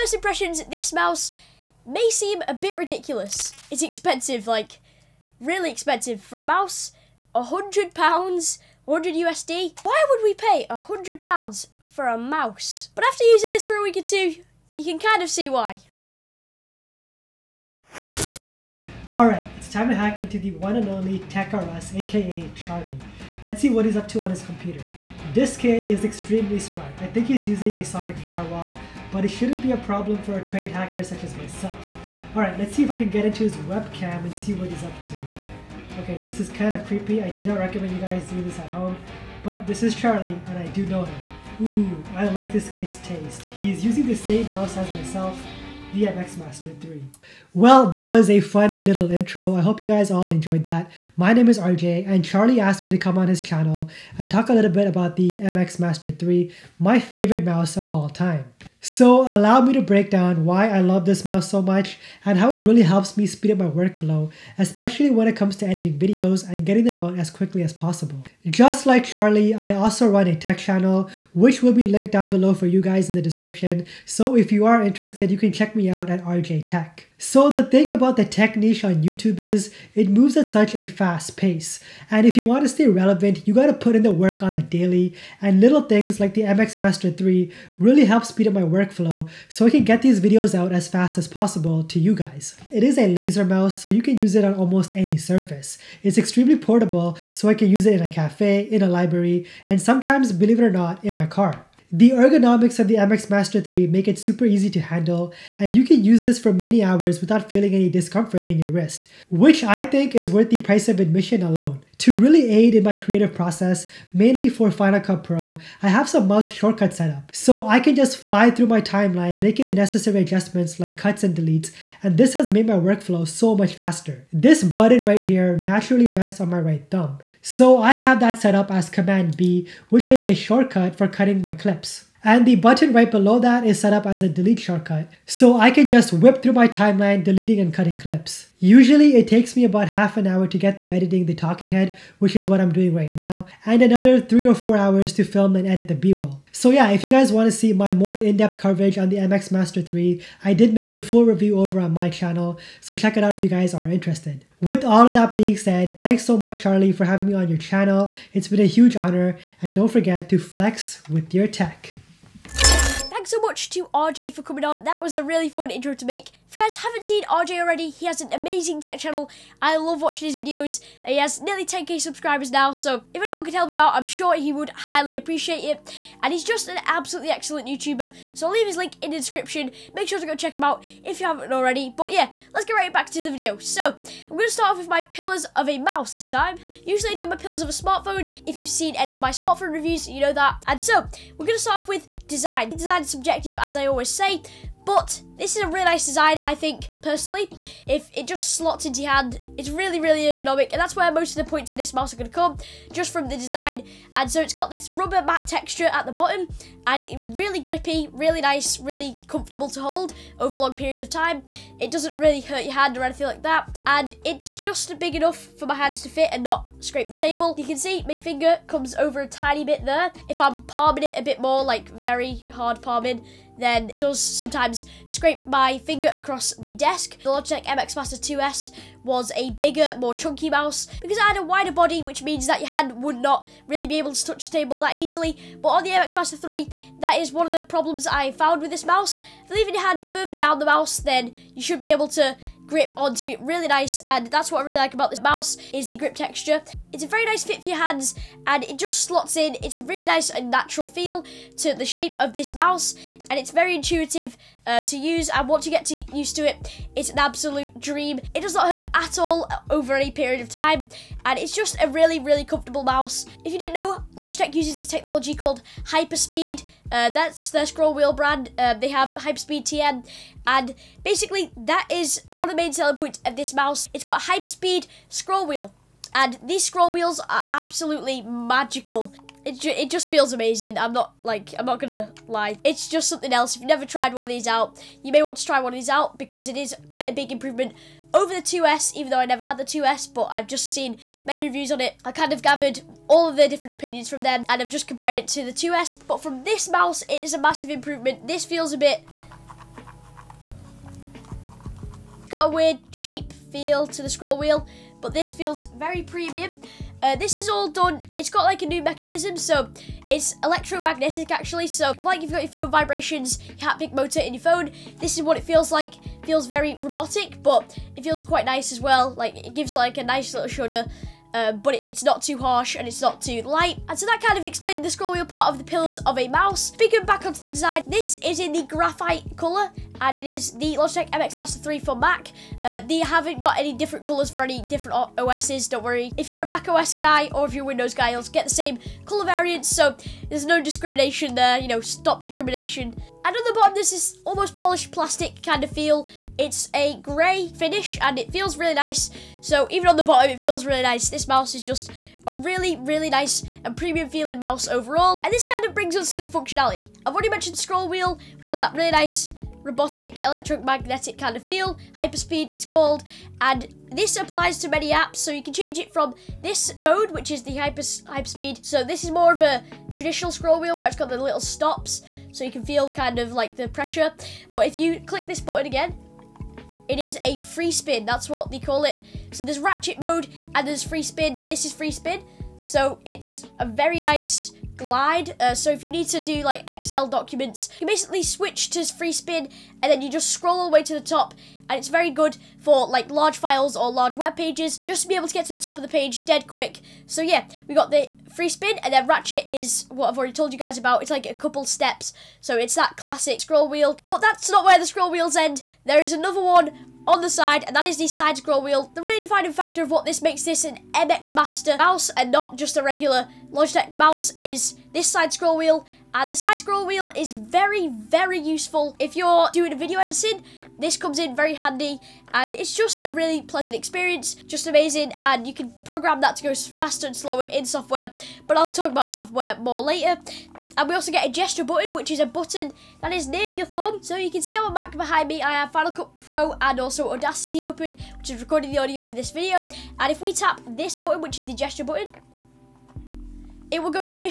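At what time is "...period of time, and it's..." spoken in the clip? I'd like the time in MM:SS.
04:20.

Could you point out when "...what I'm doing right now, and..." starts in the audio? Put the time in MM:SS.
02:22.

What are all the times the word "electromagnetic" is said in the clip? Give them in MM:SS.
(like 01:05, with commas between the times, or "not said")
05:10, 06:00.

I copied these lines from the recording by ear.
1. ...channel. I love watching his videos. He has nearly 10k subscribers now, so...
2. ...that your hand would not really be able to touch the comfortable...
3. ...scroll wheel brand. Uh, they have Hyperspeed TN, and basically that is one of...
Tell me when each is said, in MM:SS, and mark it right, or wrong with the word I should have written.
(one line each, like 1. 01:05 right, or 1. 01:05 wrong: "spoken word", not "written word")
1. 02:48 right
2. 03:52 wrong: "table", not "comfortable"
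3. 04:27 right.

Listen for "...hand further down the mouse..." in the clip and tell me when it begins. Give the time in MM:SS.
03:59.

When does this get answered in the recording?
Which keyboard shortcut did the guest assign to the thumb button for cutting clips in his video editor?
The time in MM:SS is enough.
02:08.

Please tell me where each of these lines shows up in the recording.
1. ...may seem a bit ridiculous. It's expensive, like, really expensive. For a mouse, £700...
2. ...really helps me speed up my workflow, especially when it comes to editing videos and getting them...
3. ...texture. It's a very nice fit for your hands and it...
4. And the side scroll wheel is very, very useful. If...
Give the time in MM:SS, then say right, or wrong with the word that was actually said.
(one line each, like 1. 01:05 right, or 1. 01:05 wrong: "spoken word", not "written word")
1. 00:01 wrong: "100", not "700"
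2. 01:02 right
3. 04:06 right
4. 06:56 right.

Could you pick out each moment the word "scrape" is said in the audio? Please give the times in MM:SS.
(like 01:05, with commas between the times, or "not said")
03:36, 03:45.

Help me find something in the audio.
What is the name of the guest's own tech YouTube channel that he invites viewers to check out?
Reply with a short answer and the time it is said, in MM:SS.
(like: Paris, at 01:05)
RJey Tech, at 01:16.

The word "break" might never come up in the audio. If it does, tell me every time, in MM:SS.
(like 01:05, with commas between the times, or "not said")
00:59.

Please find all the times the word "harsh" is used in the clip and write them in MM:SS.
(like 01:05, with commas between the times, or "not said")
05:22.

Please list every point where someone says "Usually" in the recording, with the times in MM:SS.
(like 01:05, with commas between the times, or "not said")
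02:18, 03:06.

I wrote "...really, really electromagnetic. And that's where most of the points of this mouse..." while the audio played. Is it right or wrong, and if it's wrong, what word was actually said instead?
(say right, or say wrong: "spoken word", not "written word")
wrong: "ergonomic", not "electromagnetic".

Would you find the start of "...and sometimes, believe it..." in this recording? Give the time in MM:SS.
01:39.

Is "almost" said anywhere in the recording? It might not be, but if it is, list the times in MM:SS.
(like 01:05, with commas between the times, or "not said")
01:34, 05:44.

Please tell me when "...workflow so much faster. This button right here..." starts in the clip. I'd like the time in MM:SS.
02:02.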